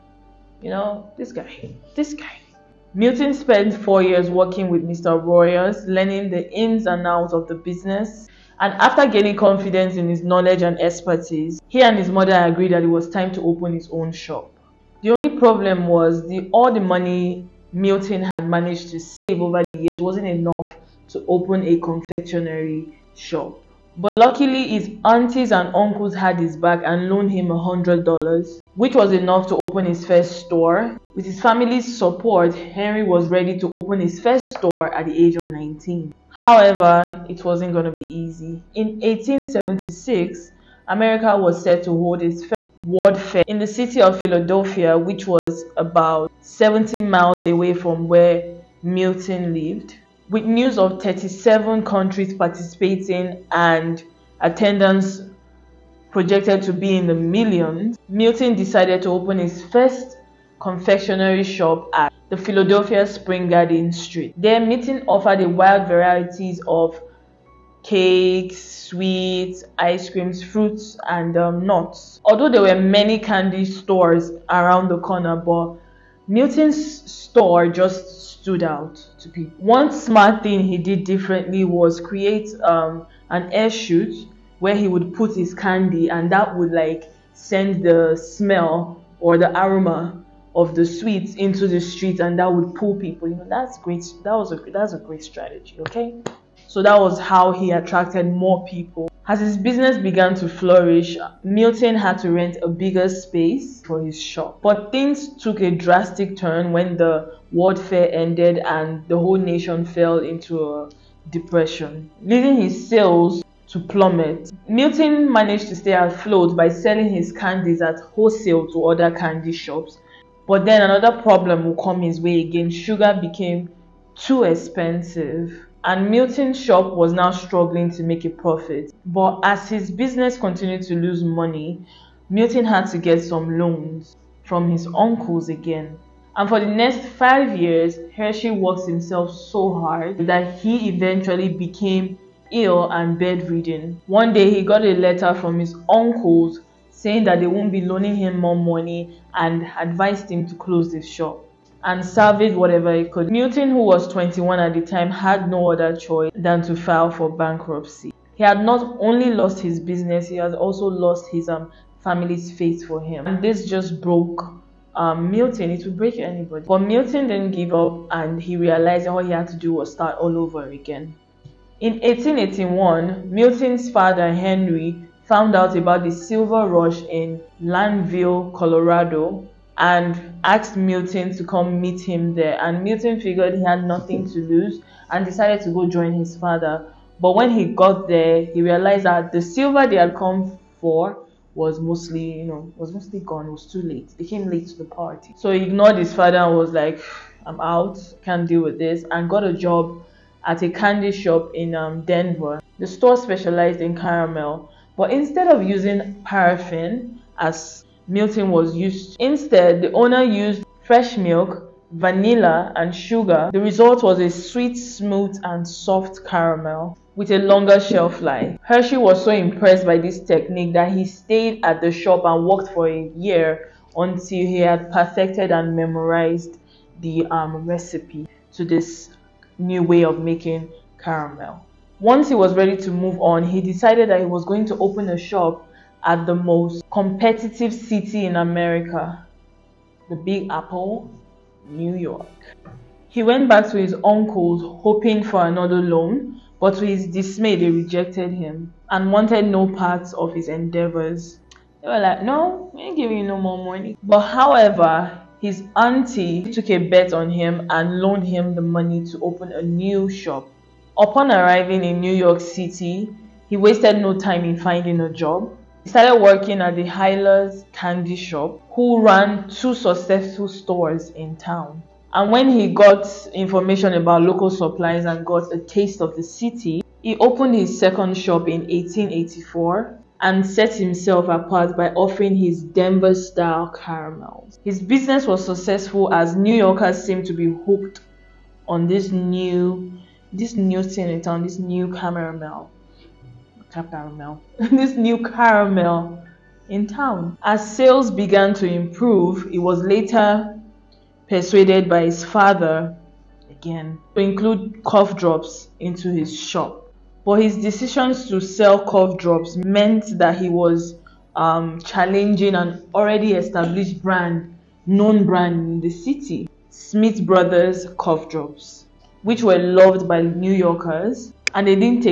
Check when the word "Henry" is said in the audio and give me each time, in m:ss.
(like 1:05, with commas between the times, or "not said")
0:32, 2:54.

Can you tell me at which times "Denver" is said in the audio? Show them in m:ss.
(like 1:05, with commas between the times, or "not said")
3:22, 4:42.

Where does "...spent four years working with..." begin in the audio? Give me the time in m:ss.
0:03.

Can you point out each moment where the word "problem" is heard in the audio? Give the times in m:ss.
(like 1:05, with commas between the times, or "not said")
0:15, 2:01.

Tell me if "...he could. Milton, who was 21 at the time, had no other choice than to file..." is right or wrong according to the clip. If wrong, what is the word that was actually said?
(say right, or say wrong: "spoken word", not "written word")
right.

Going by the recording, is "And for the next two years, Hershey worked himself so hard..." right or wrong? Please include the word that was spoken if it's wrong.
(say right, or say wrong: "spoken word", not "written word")
wrong: "five", not "two".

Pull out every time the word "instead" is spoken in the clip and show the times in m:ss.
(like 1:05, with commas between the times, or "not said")
3:25, 3:29.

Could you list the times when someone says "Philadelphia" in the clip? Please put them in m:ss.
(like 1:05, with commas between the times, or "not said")
0:44, 1:02.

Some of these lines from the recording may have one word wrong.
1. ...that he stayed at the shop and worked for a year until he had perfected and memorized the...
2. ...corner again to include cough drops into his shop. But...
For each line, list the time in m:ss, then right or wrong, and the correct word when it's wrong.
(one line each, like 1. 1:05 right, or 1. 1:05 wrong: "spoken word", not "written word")
1. 3:40 right
2. 5:02 wrong: "father", not "corner".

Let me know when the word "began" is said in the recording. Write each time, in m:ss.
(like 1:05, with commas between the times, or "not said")
1:39, 4:58.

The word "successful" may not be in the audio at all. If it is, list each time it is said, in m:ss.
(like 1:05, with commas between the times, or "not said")
4:29, 4:45.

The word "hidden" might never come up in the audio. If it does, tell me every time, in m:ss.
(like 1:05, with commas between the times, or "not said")
not said.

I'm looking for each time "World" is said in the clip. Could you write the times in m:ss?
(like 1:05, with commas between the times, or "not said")
0:42, 1:47.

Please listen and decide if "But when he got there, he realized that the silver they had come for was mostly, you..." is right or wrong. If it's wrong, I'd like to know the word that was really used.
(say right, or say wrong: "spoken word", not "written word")
right.